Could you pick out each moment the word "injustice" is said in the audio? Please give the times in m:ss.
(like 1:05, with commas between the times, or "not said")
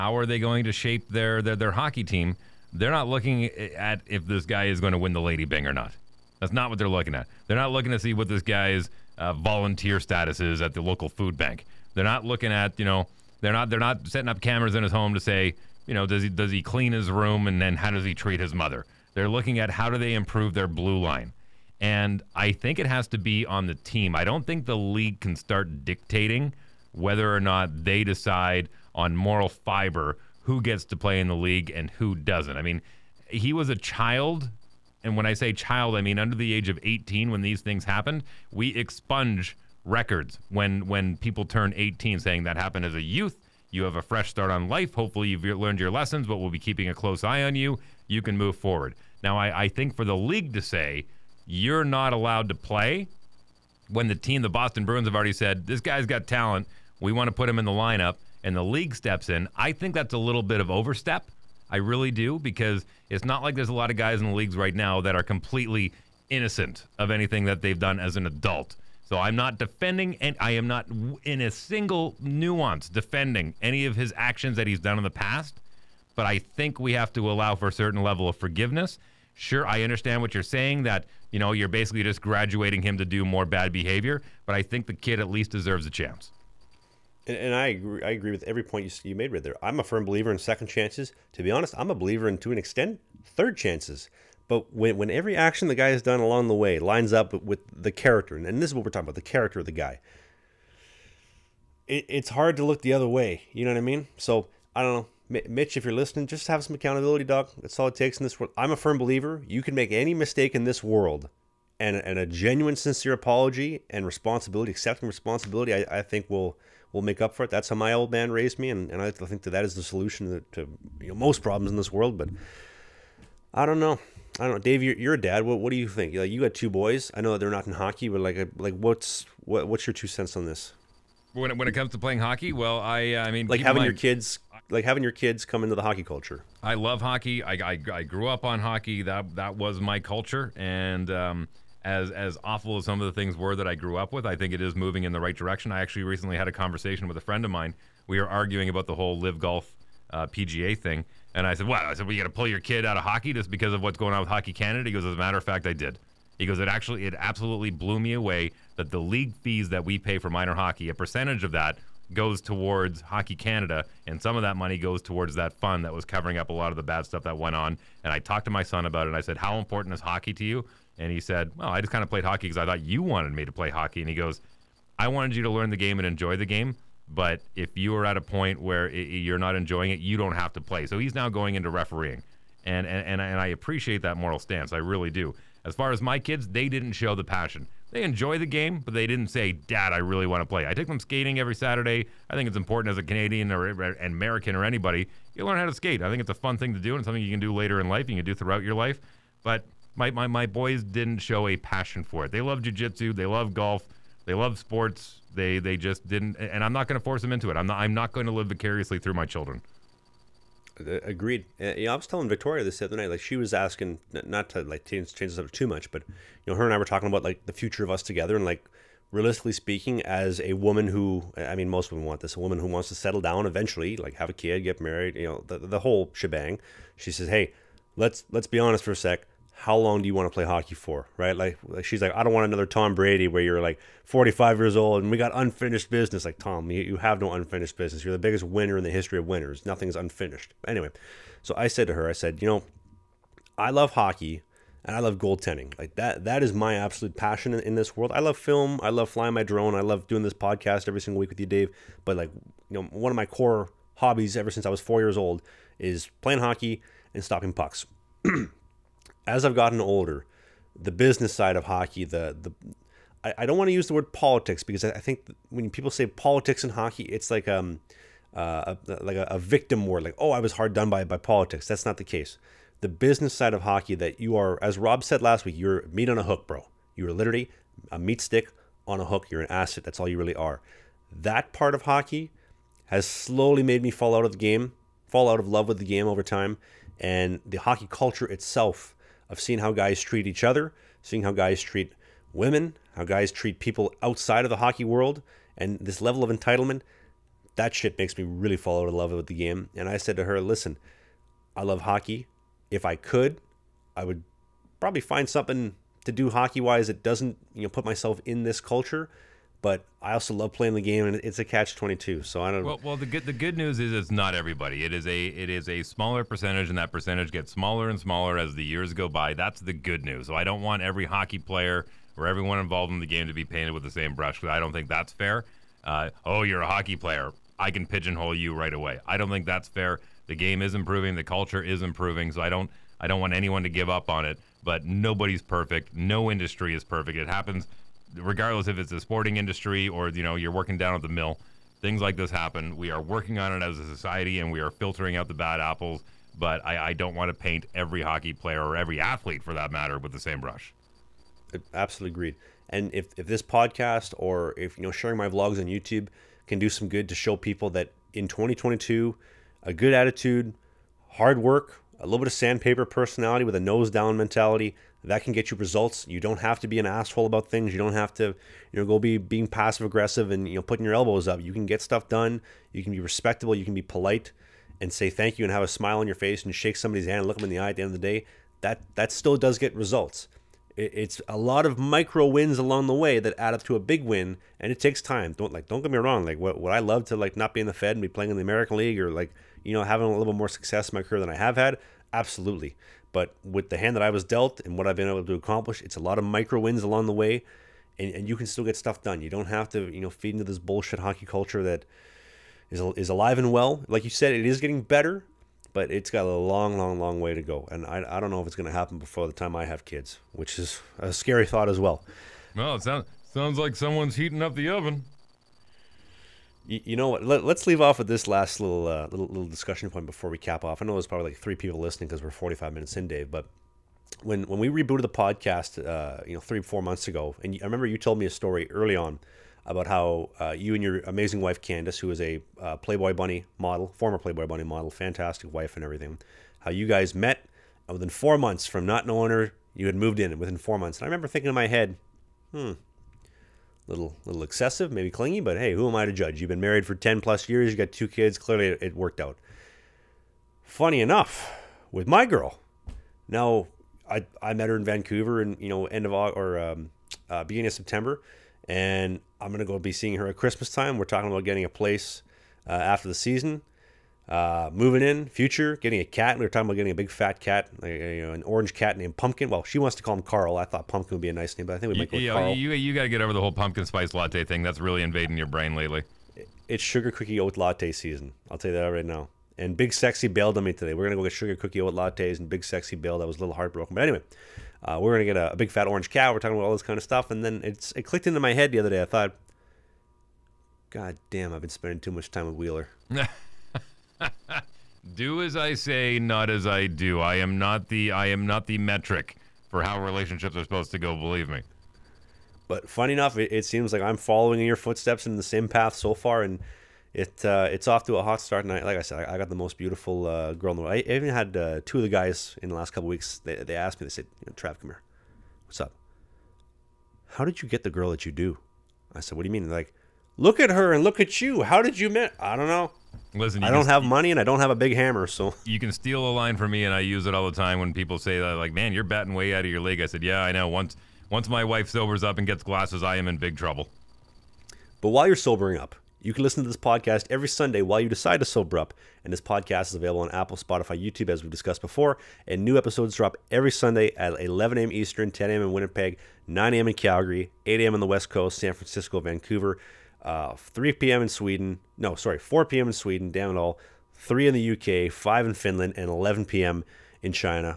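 not said.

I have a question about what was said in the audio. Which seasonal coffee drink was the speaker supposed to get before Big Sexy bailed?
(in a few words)
Sugar cookie oat latte.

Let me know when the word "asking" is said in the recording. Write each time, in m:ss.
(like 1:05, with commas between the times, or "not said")
3:33.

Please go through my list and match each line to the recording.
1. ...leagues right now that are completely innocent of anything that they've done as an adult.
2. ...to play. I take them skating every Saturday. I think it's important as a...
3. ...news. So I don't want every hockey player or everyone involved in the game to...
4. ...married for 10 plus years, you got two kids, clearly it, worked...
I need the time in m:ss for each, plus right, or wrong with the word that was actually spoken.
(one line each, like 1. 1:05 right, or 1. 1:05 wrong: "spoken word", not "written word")
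1. 1:04 right
2. 3:10 right
3. 5:20 right
4. 7:26 right.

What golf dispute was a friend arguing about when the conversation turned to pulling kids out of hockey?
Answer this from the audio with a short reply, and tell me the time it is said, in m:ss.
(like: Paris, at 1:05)
LIV Golf, at 2:29.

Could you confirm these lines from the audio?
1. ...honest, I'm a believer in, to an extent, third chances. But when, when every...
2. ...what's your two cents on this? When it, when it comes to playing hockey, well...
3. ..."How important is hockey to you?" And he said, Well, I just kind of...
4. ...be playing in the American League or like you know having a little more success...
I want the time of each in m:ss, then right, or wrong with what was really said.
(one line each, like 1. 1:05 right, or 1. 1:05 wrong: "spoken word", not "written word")
1. 1:31 right
2. 2:09 right
3. 2:49 right
4. 6:28 right.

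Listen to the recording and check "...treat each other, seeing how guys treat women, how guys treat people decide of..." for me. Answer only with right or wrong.
wrong.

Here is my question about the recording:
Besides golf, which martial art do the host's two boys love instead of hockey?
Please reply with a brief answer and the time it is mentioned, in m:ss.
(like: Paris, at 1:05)
Jujitsu, at 3:22.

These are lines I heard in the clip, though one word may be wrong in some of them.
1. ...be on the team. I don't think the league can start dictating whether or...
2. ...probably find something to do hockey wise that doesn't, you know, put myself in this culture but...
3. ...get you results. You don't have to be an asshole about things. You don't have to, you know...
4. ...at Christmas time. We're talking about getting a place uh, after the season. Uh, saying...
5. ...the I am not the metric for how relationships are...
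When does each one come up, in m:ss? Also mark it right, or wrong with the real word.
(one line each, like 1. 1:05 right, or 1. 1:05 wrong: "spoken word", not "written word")
1. 0:23 right
2. 5:04 right
3. 6:05 right
4. 7:40 wrong: "moving", not "saying"
5. 8:17 right.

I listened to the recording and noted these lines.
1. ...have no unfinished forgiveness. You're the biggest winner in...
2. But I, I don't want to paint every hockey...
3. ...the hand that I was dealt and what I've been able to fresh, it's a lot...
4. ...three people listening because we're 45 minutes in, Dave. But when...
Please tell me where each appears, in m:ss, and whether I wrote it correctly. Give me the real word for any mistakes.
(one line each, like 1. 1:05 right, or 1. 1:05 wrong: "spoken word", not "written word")
1. 3:56 wrong: "business", not "forgiveness"
2. 5:46 right
3. 6:33 wrong: "accomplish", not "fresh"
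4. 7:01 right.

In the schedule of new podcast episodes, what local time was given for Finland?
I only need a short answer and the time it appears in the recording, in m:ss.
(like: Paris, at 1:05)
5, at 9:15.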